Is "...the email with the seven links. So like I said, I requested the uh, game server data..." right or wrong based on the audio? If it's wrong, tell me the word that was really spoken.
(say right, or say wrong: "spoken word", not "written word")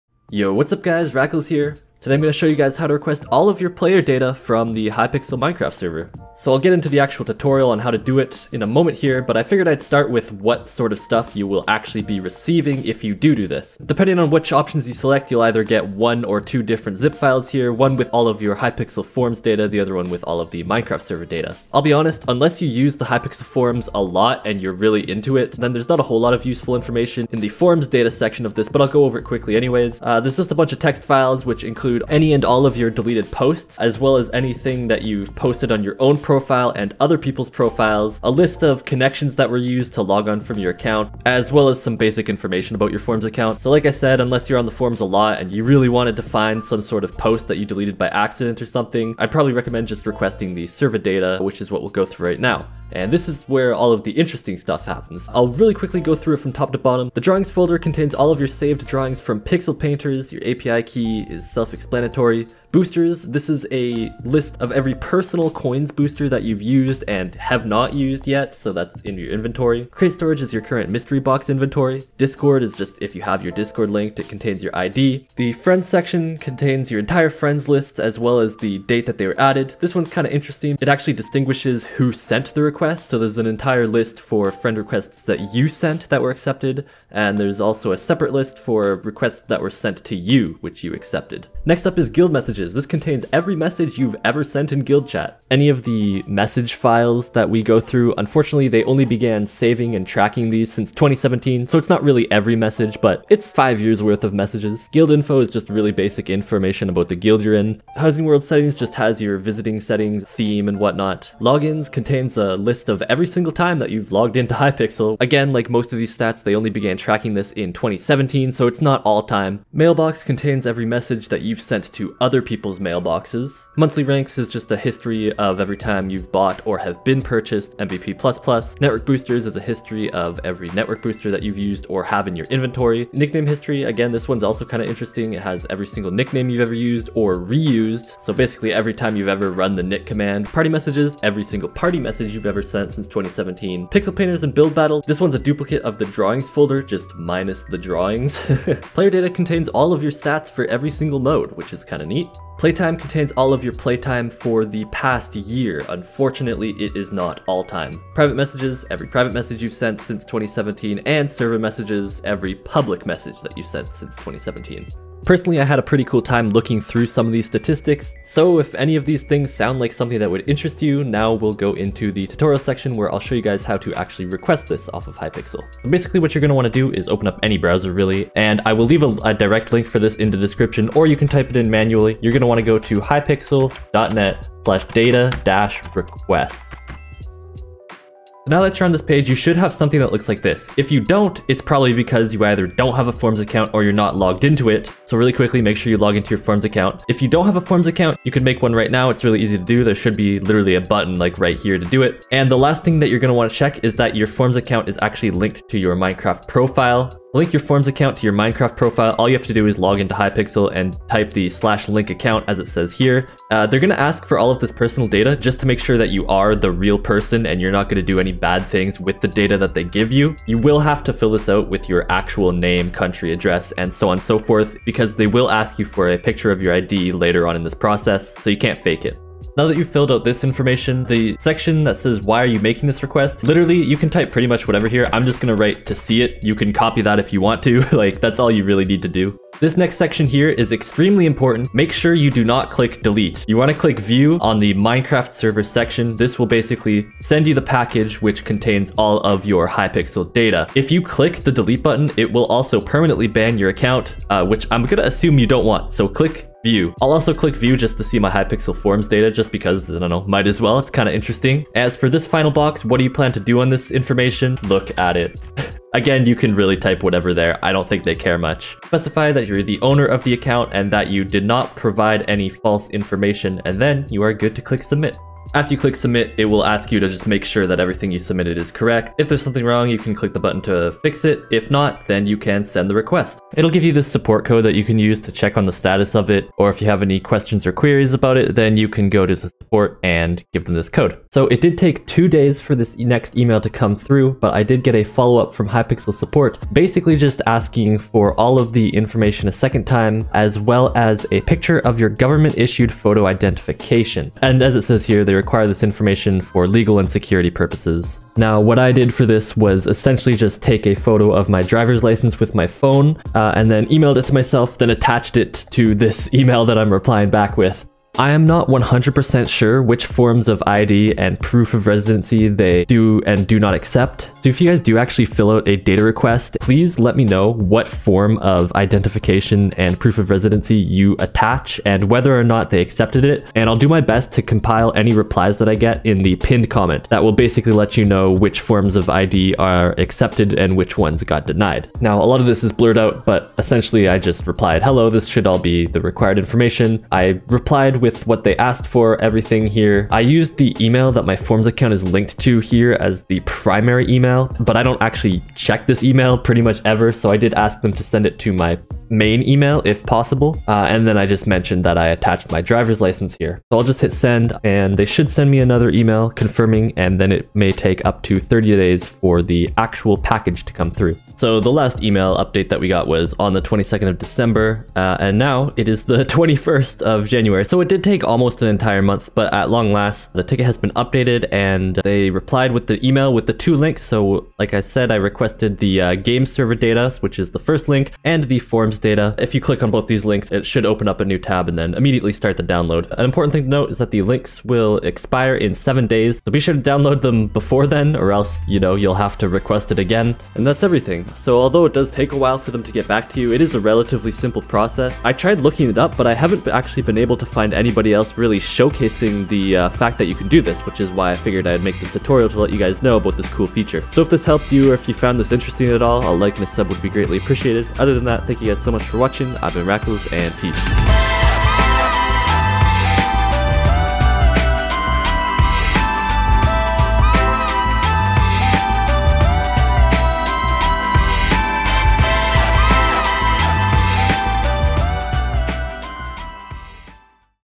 wrong: "two", not "seven".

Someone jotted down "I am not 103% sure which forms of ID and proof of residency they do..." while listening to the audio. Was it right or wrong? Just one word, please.
wrong.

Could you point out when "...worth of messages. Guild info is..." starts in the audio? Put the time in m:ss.
1:44.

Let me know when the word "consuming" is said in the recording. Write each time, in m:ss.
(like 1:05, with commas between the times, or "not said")
not said.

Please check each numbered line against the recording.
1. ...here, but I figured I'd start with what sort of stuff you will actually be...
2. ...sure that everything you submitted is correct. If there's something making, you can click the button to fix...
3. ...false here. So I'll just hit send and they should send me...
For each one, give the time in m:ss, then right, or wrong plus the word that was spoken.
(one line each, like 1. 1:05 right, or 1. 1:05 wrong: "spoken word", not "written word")
1. 0:08 right
2. 4:37 wrong: "wrong", not "making"
3. 6:03 wrong: "license", not "false".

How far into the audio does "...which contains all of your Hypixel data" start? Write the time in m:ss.
4:08.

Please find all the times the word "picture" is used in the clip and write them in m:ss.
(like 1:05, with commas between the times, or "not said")
3:46, 5:01.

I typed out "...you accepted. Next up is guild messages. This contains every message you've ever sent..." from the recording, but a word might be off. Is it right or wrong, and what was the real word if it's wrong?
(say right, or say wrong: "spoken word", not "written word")
right.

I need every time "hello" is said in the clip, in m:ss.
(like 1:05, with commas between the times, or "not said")
5:44.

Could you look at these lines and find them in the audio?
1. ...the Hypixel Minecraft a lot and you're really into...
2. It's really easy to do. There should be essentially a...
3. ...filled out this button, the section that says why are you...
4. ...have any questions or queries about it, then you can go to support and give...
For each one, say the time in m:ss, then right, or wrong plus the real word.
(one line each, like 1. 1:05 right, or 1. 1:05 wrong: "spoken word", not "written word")
1. 0:22 wrong: "Forums", not "Minecraft"
2. 3:19 wrong: "literally", not "essentially"
3. 3:49 wrong: "information", not "button"
4. 4:46 right.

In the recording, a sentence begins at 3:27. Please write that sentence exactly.
Link your Forums account to your Minecraft profile.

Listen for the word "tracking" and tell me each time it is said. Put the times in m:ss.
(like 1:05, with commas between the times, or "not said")
1:40, 1:56.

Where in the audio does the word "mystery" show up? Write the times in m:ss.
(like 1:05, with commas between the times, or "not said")
1:10.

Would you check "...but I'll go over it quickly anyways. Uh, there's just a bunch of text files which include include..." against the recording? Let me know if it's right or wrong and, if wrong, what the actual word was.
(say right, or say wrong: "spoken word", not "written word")
right.